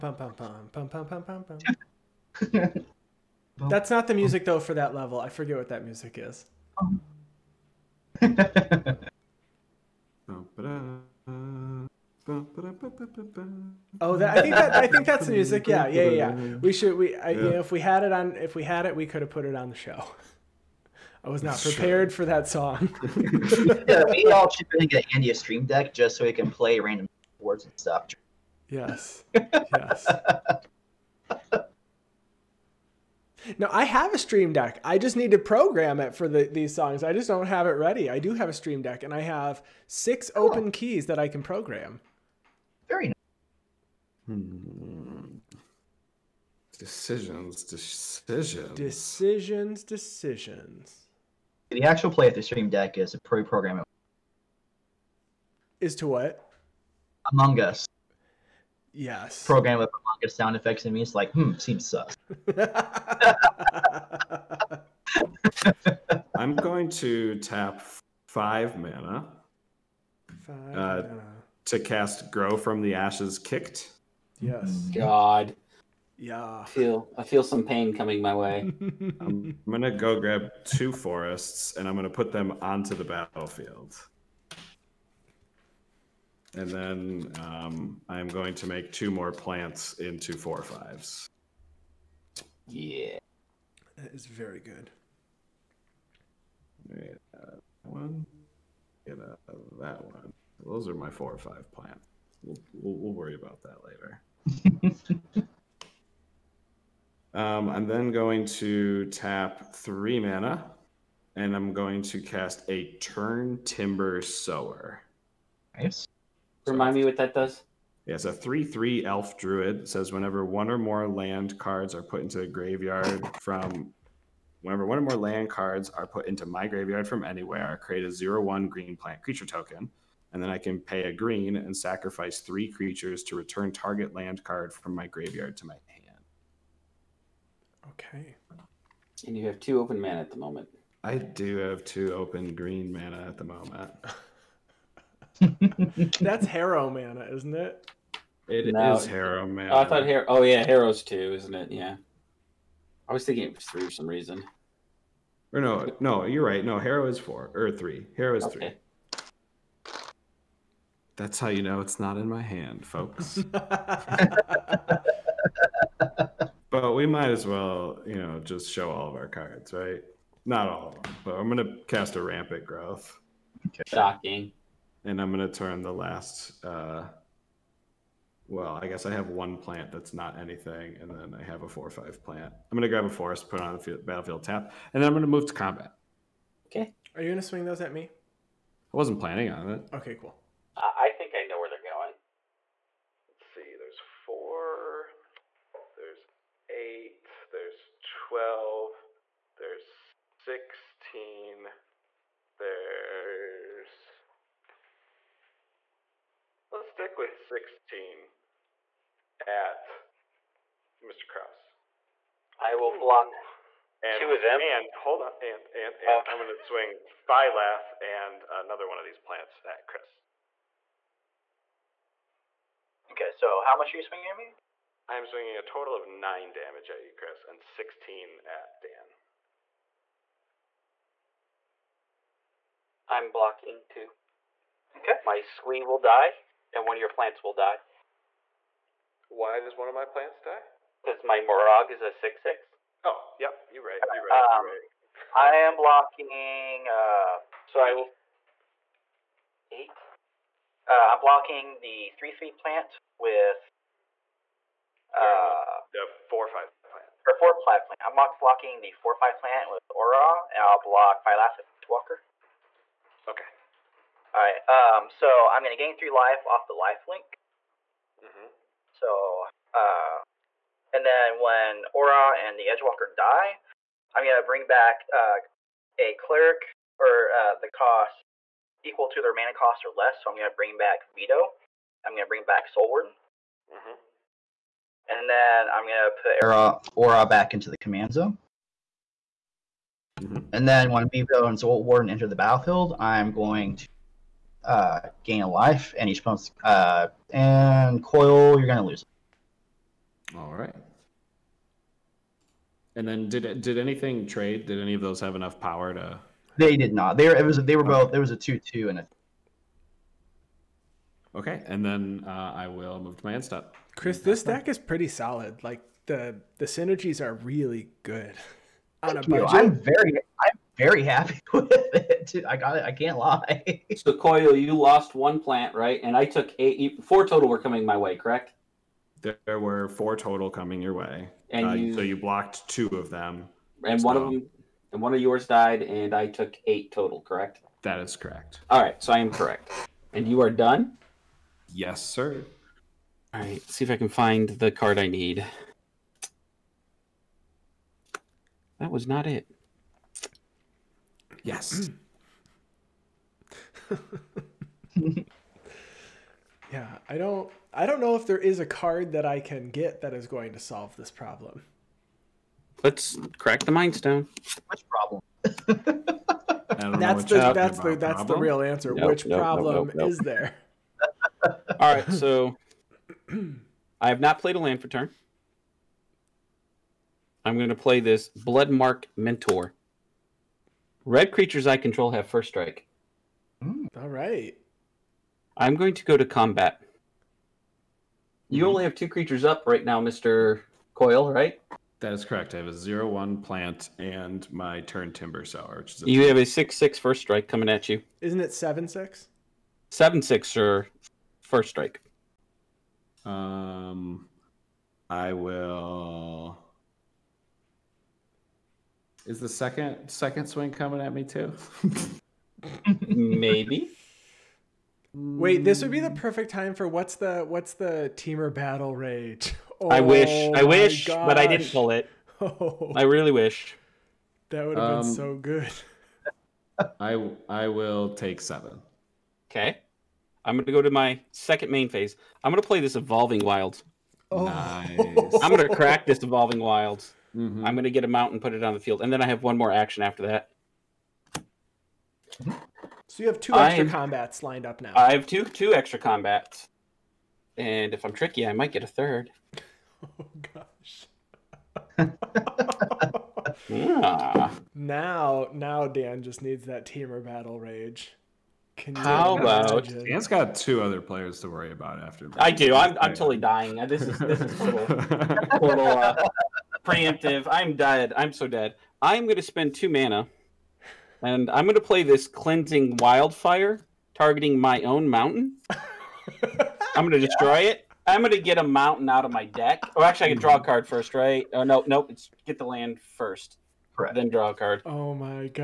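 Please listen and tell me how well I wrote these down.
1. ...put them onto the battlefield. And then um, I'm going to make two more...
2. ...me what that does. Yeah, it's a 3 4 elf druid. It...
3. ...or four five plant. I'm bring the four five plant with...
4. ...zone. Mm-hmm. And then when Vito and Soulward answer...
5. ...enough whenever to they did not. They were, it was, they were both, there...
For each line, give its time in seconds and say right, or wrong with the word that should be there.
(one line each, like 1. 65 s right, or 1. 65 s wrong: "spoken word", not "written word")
1. 82 s right
2. 116 s wrong: "3", not "4"
3. 257 s wrong: "blocking", not "bring"
4. 288 s wrong: "enter", not "answer"
5. 305 s wrong: "power", not "whenever".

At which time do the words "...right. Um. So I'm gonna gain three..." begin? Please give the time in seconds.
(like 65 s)
264 s.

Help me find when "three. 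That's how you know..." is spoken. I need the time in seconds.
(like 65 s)
158 s.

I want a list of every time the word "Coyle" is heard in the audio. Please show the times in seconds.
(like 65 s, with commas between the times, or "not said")
298 s, 324 s, 390 s.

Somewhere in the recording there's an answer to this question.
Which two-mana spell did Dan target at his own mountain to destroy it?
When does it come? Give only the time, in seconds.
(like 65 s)
472 s.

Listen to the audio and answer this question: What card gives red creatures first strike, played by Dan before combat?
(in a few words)
Bloodmark Mentor.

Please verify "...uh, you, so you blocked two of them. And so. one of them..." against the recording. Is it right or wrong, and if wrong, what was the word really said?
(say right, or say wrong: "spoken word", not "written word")
right.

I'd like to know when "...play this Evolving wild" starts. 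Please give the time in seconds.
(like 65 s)
432 s.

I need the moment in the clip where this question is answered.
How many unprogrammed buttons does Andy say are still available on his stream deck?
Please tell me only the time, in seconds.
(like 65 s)
39 s.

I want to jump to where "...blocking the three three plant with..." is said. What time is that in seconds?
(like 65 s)
251 s.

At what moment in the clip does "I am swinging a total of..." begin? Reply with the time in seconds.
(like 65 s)
225 s.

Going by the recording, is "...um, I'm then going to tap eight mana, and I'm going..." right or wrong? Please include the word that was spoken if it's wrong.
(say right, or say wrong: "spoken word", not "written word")
wrong: "three", not "eight".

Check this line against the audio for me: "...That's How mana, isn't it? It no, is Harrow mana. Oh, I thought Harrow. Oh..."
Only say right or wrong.
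wrong.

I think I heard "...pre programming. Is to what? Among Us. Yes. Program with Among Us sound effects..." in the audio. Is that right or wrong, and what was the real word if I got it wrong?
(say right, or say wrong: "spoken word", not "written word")
right.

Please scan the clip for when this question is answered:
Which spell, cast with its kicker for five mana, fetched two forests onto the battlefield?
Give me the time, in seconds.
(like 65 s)
72 s.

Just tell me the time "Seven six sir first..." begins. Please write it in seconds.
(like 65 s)
399 s.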